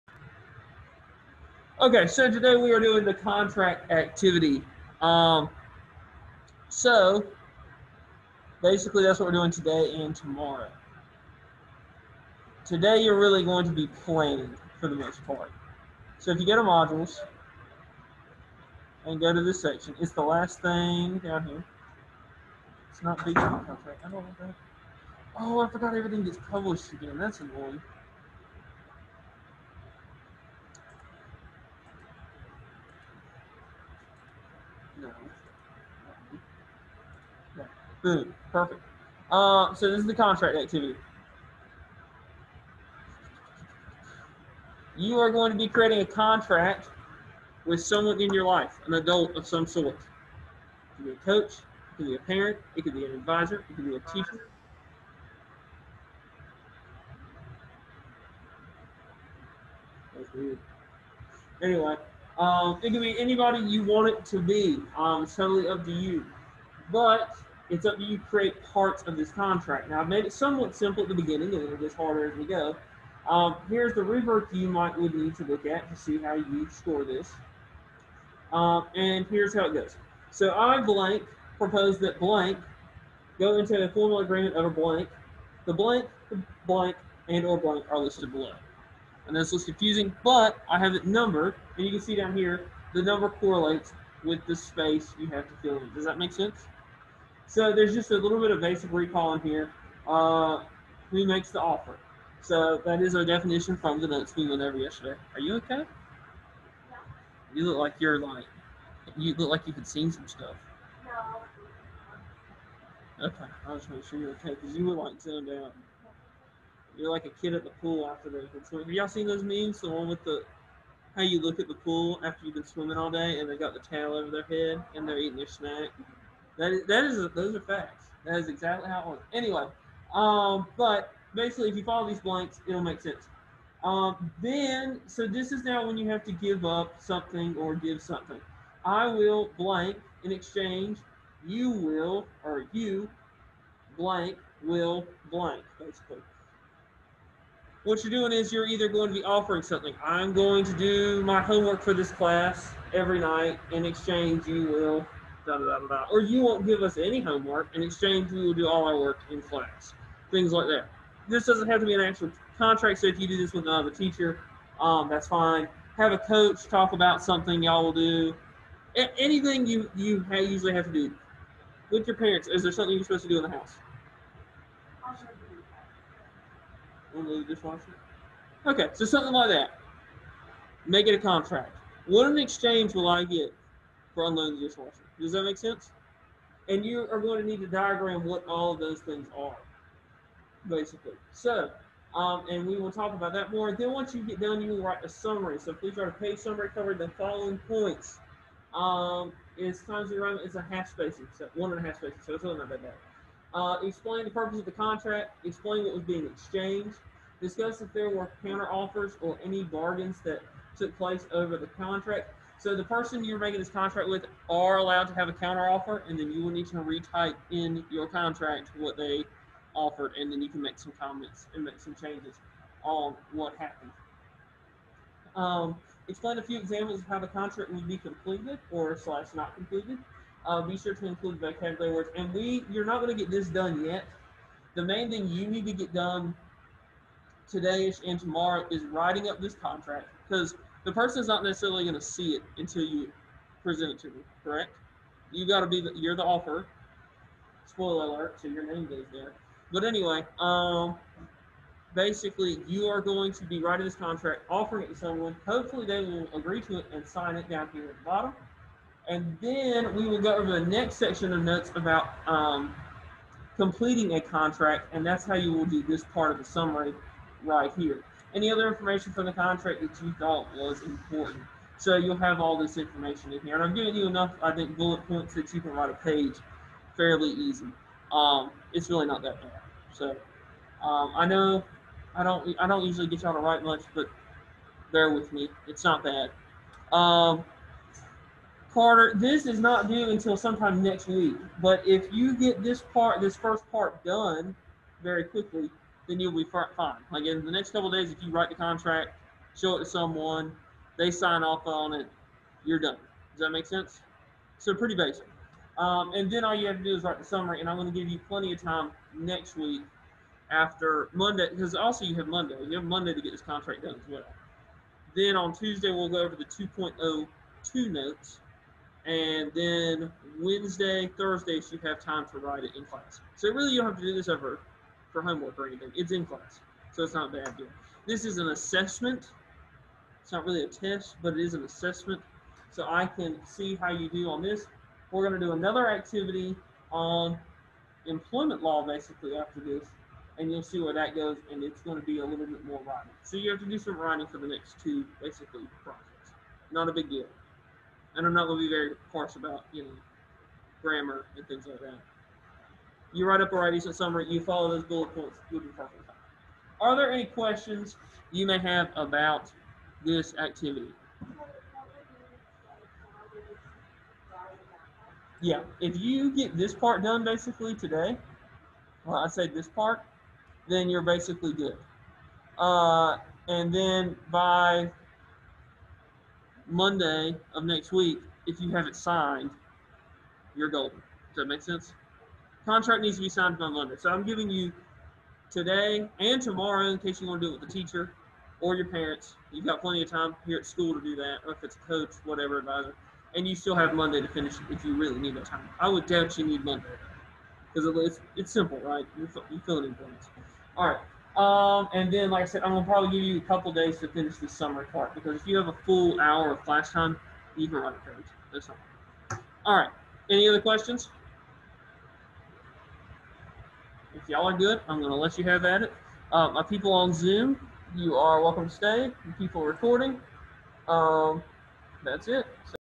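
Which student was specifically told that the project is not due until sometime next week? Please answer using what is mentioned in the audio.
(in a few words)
Carter.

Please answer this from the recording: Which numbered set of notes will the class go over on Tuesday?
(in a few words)
2.02.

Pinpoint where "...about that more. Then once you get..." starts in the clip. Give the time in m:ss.
3:13.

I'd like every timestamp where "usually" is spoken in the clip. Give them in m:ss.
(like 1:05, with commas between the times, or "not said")
2:50, 4:42.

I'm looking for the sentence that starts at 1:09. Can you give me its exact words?
Now, I've made it somewhat simple at the beginning, and it gets harder as we go.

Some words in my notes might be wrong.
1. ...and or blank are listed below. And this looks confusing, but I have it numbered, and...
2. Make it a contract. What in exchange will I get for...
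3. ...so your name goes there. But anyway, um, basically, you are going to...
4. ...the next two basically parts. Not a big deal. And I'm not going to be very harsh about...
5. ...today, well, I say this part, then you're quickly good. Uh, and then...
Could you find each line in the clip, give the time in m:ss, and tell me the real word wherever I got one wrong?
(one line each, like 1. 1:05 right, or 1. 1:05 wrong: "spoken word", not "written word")
1. 1:27 right
2. 3:00 right
3. 4:08 right
4. 5:44 wrong: "projects", not "parts"
5. 6:07 wrong: "basically", not "quickly".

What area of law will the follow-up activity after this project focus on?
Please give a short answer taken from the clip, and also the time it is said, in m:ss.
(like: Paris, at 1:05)
employment law, at 5:38.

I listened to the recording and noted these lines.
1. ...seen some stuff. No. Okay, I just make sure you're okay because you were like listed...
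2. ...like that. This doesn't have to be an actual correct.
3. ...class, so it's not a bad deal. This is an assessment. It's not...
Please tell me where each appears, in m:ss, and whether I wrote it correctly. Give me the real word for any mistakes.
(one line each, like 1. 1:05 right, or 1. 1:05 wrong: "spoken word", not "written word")
1. 1:49 wrong: "zoned", not "listed"
2. 2:40 wrong: "contract", not "correct"
3. 5:26 right.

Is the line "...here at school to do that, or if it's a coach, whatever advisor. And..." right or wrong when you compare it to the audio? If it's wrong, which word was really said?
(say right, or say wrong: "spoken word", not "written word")
right.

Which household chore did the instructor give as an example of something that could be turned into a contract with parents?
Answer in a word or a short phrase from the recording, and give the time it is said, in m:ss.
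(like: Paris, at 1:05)
Unload the dishwasher, at 2:57.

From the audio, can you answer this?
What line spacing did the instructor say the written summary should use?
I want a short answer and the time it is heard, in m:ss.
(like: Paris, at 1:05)
1.5 spacing, at 3:21.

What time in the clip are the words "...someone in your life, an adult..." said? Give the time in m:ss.
0:47.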